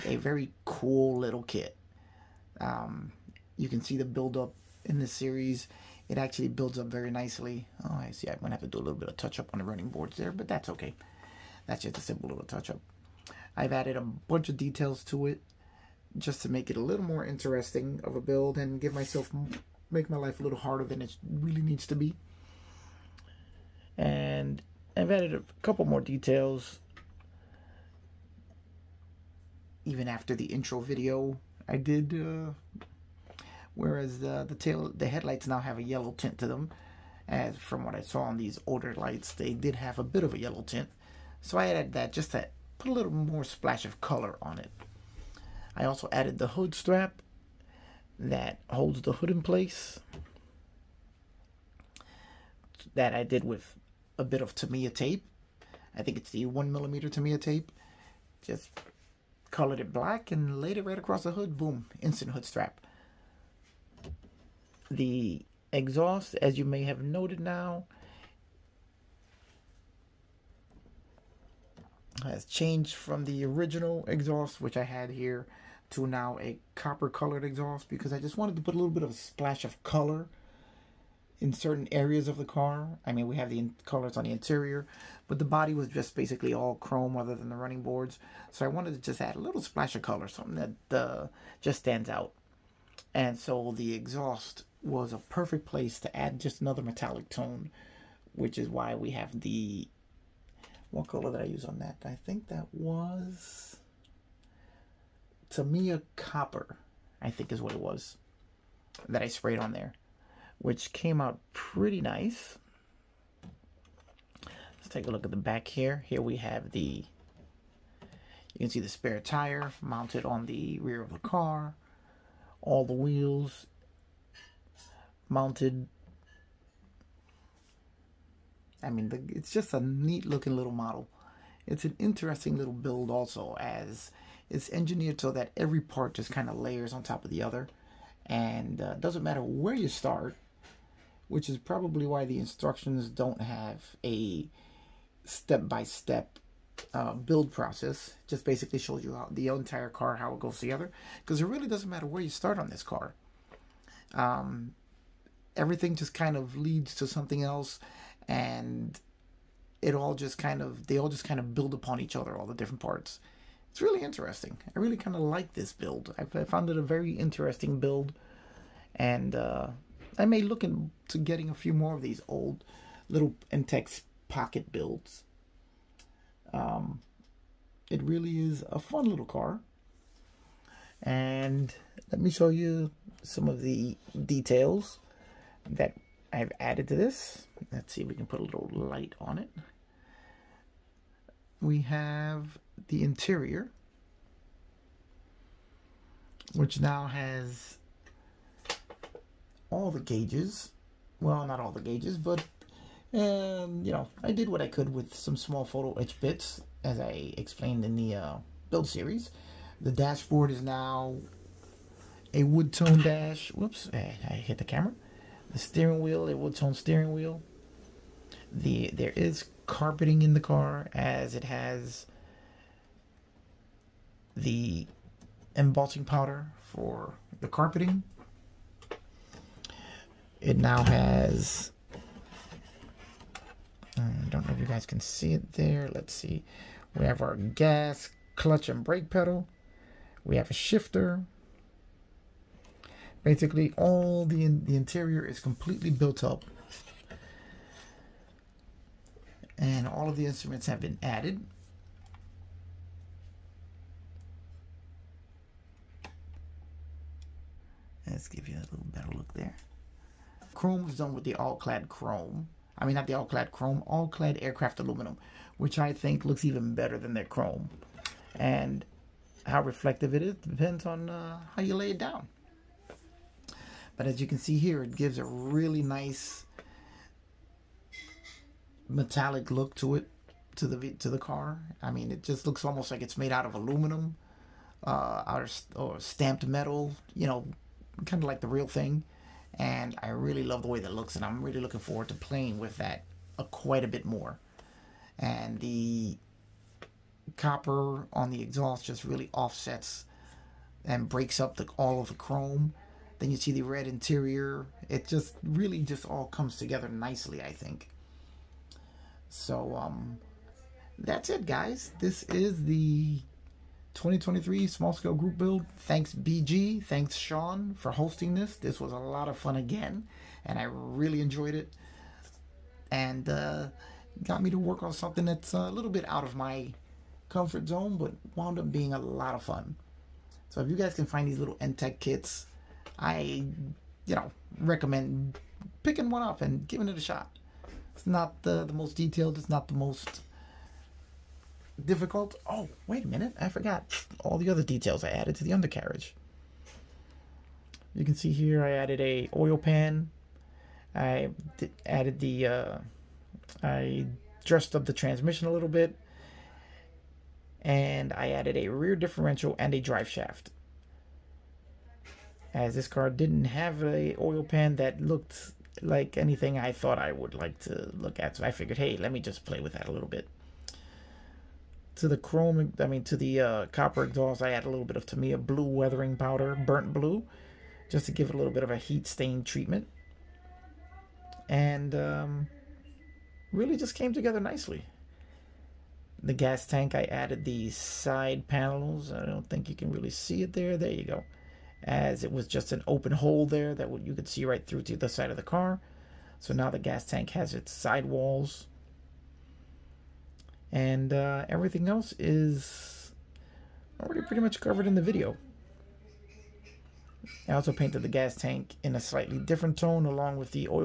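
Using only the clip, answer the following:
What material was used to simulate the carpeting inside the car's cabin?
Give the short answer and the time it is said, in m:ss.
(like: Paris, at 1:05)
embossing powder, at 3:45.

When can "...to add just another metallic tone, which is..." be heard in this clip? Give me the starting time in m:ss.
1:36.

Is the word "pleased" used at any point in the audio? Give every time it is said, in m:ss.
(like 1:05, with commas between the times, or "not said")
not said.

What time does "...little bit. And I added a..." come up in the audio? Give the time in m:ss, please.
5:55.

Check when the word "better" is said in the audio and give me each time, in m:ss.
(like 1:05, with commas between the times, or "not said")
4:18, 4:26.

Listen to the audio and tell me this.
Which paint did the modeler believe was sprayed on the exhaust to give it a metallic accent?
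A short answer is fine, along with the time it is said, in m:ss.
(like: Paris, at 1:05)
Tamiya Copper, at 1:45.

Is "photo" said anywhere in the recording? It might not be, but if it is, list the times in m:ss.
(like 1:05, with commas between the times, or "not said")
3:25.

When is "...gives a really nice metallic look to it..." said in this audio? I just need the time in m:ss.
4:34.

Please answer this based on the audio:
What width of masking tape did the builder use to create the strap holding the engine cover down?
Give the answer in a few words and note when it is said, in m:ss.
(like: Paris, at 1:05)
1 millimeter, at 0:56.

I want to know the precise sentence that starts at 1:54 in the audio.
Let's take a look at the back here.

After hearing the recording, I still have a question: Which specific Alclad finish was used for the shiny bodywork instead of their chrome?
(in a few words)
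Alclad aircraft aluminum.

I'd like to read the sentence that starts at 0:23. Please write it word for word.
And I've added a couple more details.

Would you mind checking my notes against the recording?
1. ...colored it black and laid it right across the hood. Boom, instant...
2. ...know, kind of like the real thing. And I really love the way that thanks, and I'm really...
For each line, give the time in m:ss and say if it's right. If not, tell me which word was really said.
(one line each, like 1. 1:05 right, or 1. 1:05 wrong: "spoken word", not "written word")
1. 0:59 right
2. 4:47 wrong: "looks", not "thanks".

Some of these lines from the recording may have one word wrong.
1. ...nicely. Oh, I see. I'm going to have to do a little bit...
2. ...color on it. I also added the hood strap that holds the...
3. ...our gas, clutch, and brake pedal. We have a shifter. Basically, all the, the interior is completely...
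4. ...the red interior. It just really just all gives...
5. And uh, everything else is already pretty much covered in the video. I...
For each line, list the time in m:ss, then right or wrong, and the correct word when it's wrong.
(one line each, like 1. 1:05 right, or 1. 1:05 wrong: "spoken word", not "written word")
1. 0:07 right
2. 0:44 right
3. 3:57 right
4. 5:03 wrong: "comes", not "gives"
5. 6:40 right.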